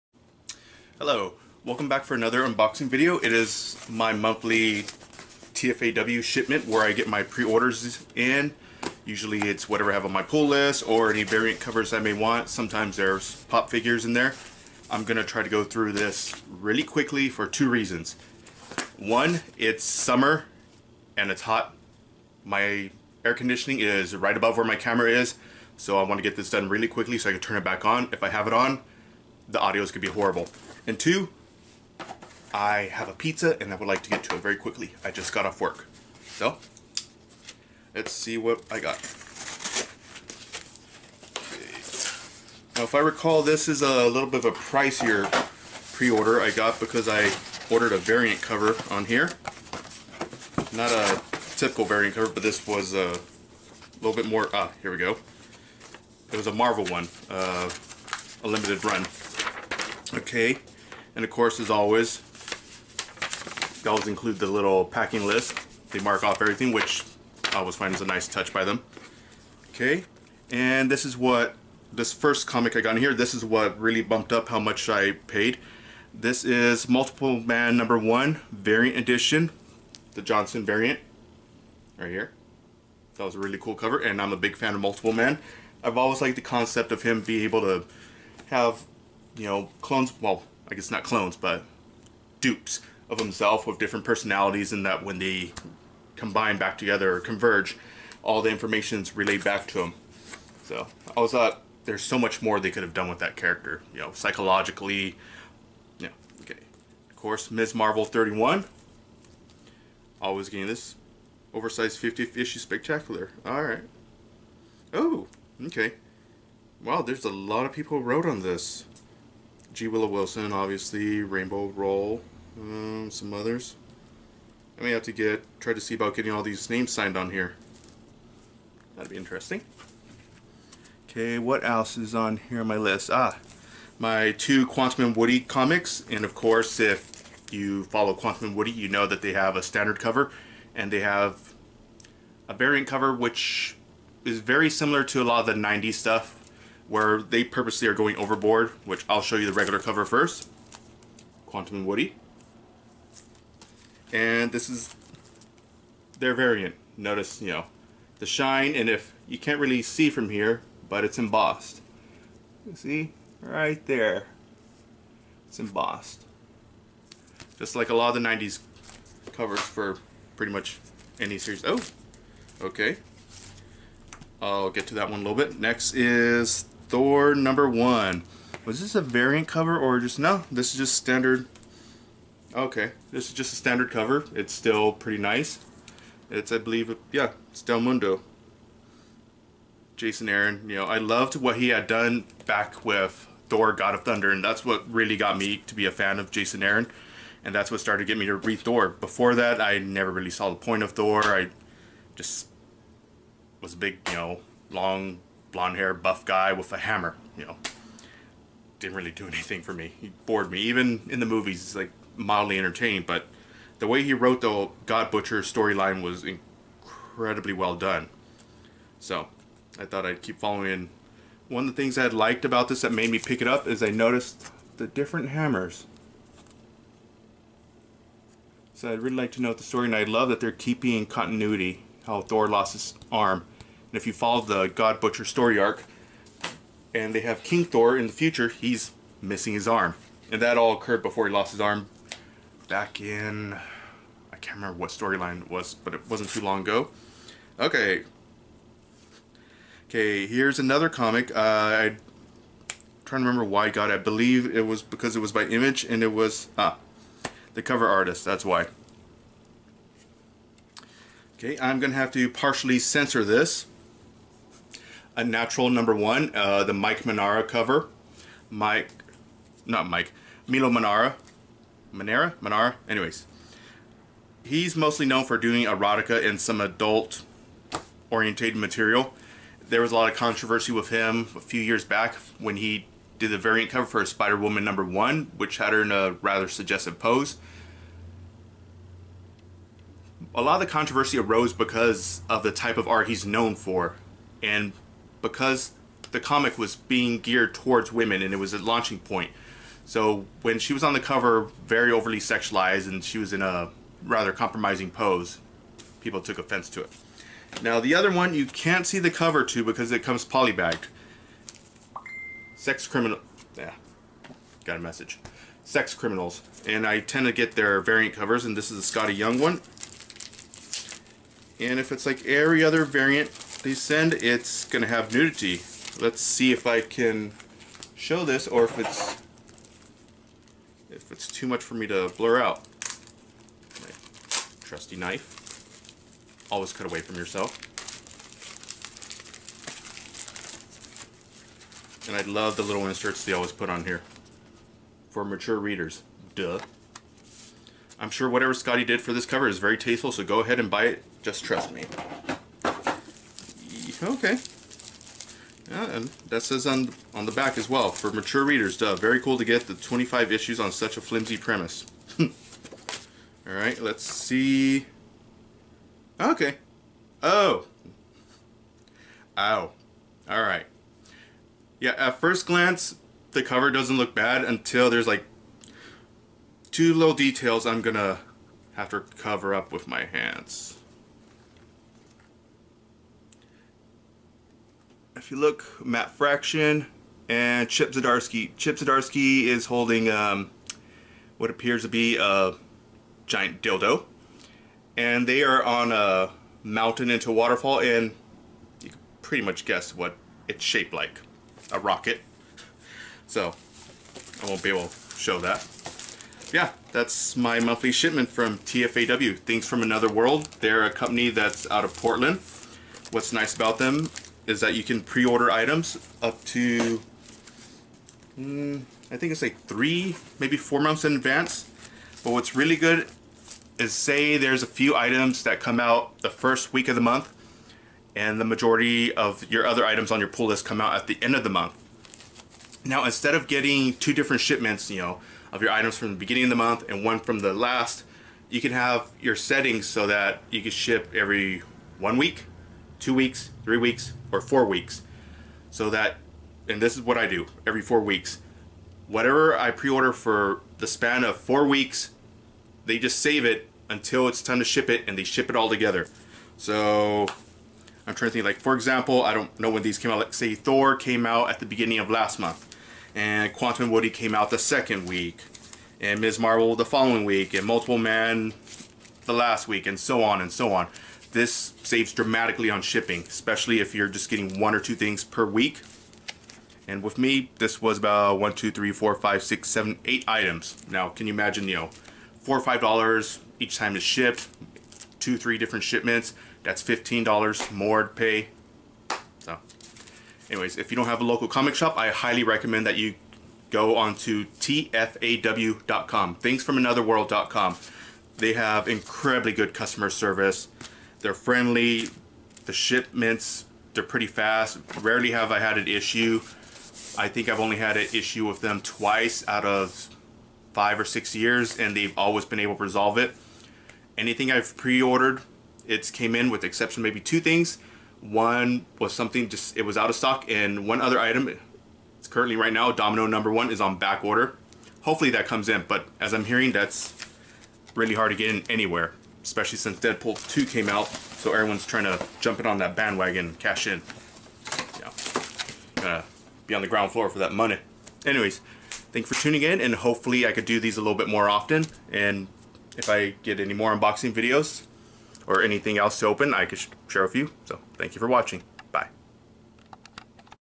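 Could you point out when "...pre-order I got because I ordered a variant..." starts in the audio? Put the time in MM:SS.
00:45.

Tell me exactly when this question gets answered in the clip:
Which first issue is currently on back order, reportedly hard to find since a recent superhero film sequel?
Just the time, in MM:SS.
08:42.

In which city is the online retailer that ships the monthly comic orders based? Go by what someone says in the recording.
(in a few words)
Portland.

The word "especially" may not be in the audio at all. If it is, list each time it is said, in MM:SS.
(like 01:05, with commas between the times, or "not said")
07:53, 08:49.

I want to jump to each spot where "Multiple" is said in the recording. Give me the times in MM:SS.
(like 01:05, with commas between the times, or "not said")
01:16, 01:24, 07:47.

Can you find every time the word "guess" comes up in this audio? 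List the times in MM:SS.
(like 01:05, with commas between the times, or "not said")
01:30, 06:39.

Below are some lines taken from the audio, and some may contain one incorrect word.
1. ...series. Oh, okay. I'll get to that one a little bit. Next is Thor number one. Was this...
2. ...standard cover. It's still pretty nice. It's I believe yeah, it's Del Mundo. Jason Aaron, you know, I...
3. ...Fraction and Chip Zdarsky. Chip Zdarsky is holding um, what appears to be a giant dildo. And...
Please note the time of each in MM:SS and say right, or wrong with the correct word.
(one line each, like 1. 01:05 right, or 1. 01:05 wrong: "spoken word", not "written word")
1. 02:51 right
2. 03:03 right
3. 06:26 right.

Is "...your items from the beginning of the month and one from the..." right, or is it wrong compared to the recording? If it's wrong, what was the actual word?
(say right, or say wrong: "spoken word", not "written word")
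right.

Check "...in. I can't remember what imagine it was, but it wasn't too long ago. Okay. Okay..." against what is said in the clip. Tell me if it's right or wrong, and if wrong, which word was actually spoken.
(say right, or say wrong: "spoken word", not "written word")
wrong: "storyline", not "imagine".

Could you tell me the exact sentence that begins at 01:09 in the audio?
Okay, and this is what, this first comic I got in here, this is what really bumped up how much I paid.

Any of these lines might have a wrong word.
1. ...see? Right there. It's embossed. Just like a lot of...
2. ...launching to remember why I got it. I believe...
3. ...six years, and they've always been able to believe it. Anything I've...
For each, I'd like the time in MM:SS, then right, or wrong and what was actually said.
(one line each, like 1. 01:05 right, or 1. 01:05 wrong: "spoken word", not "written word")
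1. 02:42 right
2. 04:13 wrong: "trying", not "launching"
3. 08:31 wrong: "resolve", not "believe".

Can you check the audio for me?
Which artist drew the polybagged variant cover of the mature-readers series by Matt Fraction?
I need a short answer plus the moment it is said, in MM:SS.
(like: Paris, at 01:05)
Skottie Young, at 05:18.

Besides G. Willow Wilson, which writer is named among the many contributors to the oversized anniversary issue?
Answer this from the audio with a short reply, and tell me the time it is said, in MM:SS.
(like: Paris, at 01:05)
Rainbow Rowell, at 02:01.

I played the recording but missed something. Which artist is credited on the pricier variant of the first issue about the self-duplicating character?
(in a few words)
Johnson.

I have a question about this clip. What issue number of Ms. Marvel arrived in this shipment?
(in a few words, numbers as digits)
31.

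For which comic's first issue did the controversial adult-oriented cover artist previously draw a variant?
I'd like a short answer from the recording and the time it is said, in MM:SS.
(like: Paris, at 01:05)
Spider Woman, at 04:44.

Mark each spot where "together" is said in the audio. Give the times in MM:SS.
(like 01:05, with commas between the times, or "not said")
01:36, 07:35.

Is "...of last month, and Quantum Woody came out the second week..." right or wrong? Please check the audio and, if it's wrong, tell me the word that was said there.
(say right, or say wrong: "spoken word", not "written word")
right.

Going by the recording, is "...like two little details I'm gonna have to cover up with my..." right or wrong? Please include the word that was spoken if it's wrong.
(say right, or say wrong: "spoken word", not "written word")
right.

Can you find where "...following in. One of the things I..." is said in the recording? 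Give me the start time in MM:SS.
03:40.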